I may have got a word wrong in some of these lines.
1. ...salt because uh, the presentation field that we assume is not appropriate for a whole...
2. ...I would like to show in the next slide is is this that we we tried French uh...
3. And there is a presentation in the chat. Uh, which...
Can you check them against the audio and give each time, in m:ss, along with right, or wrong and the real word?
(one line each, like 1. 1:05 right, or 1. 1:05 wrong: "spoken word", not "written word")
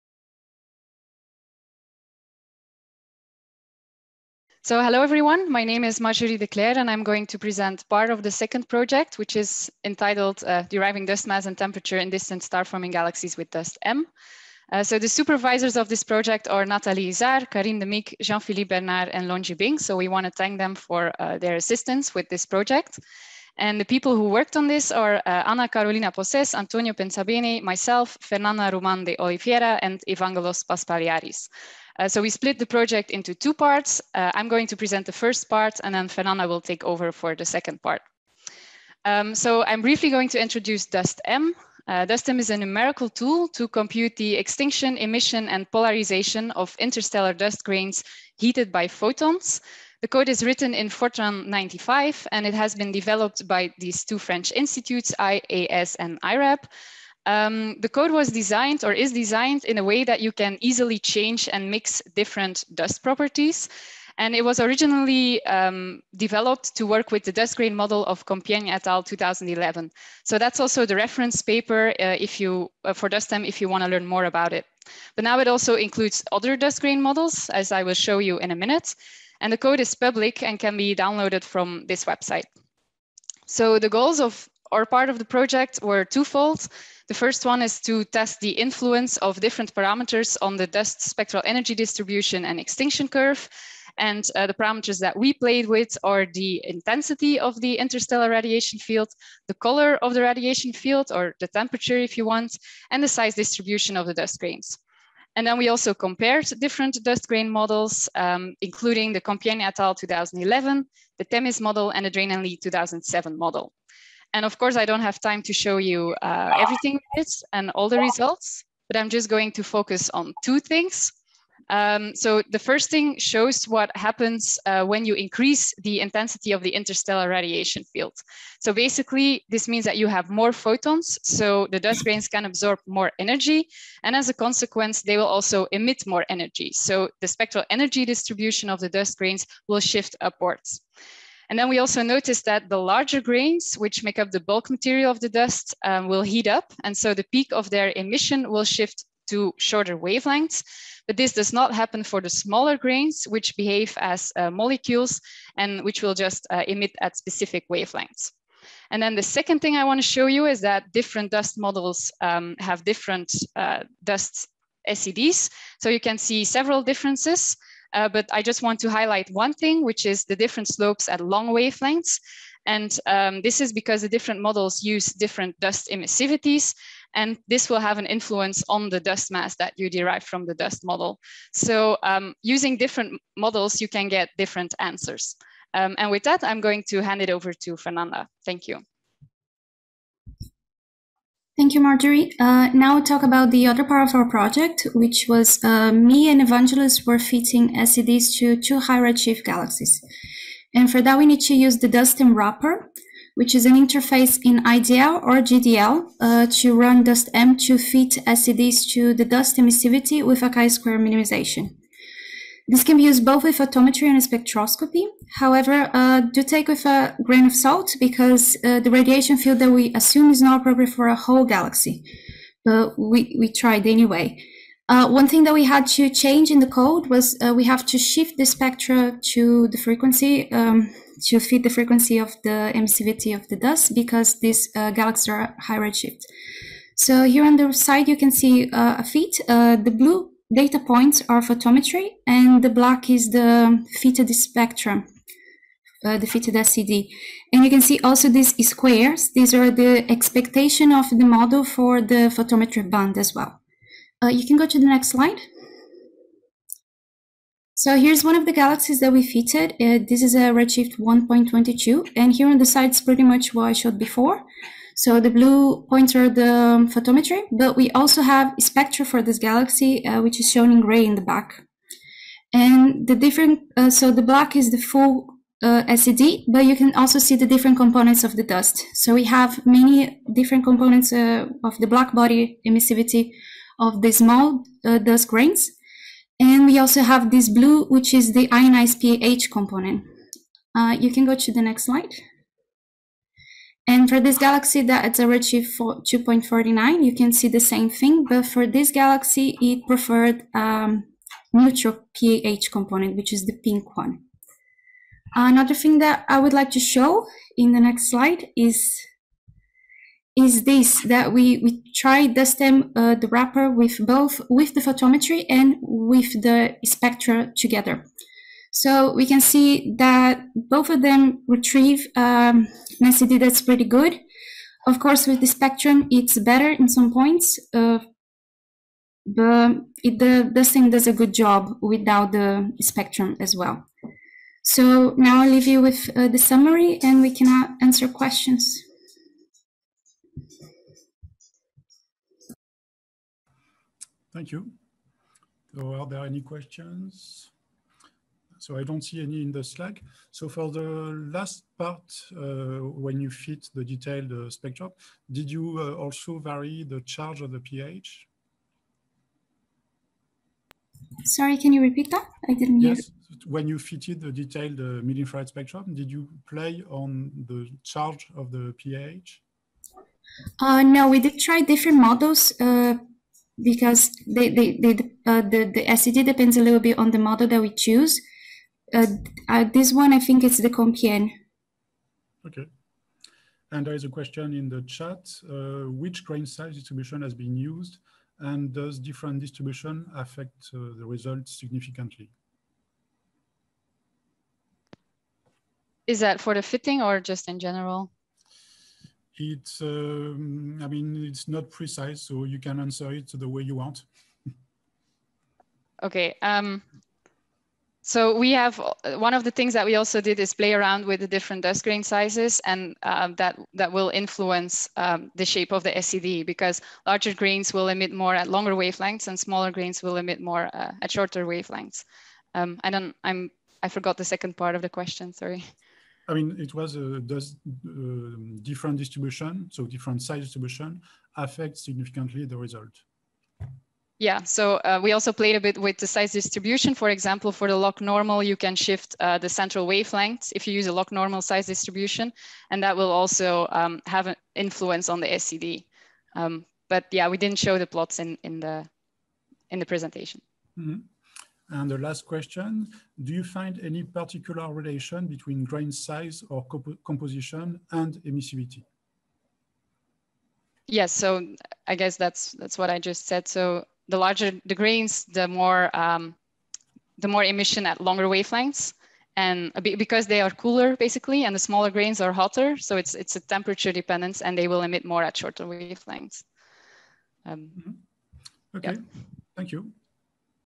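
1. 3:37 wrong: "radiation", not "presentation"
2. 5:06 wrong: "DustEM", not "French"
3. 6:23 wrong: "question", not "presentation".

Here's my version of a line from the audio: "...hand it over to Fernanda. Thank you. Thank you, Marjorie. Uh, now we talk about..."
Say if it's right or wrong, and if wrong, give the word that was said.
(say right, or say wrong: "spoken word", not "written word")
right.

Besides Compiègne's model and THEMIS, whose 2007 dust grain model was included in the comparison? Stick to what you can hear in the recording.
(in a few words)
Draine and Li.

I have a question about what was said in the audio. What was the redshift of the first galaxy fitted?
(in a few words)
1.22.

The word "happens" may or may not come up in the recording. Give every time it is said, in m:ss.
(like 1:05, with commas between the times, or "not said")
2:03, 2:31.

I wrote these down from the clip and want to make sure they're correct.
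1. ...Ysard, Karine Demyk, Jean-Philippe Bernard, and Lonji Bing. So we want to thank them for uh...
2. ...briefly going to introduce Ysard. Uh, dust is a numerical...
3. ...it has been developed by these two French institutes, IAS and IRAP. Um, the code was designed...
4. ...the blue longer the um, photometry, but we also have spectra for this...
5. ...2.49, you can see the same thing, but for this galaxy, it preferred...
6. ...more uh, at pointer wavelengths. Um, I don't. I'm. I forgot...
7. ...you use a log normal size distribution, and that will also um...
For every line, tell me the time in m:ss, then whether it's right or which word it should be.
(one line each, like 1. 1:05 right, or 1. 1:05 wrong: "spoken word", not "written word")
1. 0:17 right
2. 0:39 wrong: "DustEM", not "Ysard"
3. 0:52 right
4. 4:25 wrong: "pointer", not "longer"
5. 4:55 right
6. 7:00 wrong: "shorter", not "pointer"
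7. 7:20 right.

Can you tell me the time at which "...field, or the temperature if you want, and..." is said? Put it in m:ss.
1:40.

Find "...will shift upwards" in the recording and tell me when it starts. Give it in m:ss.
2:19.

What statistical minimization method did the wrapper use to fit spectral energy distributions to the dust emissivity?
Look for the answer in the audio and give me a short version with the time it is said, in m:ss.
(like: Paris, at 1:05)
chi-square, at 3:30.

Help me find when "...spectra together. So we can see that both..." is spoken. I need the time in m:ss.
5:16.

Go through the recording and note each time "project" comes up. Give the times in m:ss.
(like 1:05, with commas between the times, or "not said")
0:08, 0:16, 0:22, 0:32, 1:25, 3:14.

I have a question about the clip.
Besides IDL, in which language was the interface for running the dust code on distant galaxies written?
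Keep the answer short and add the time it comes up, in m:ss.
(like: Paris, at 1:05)
GDL, at 3:25.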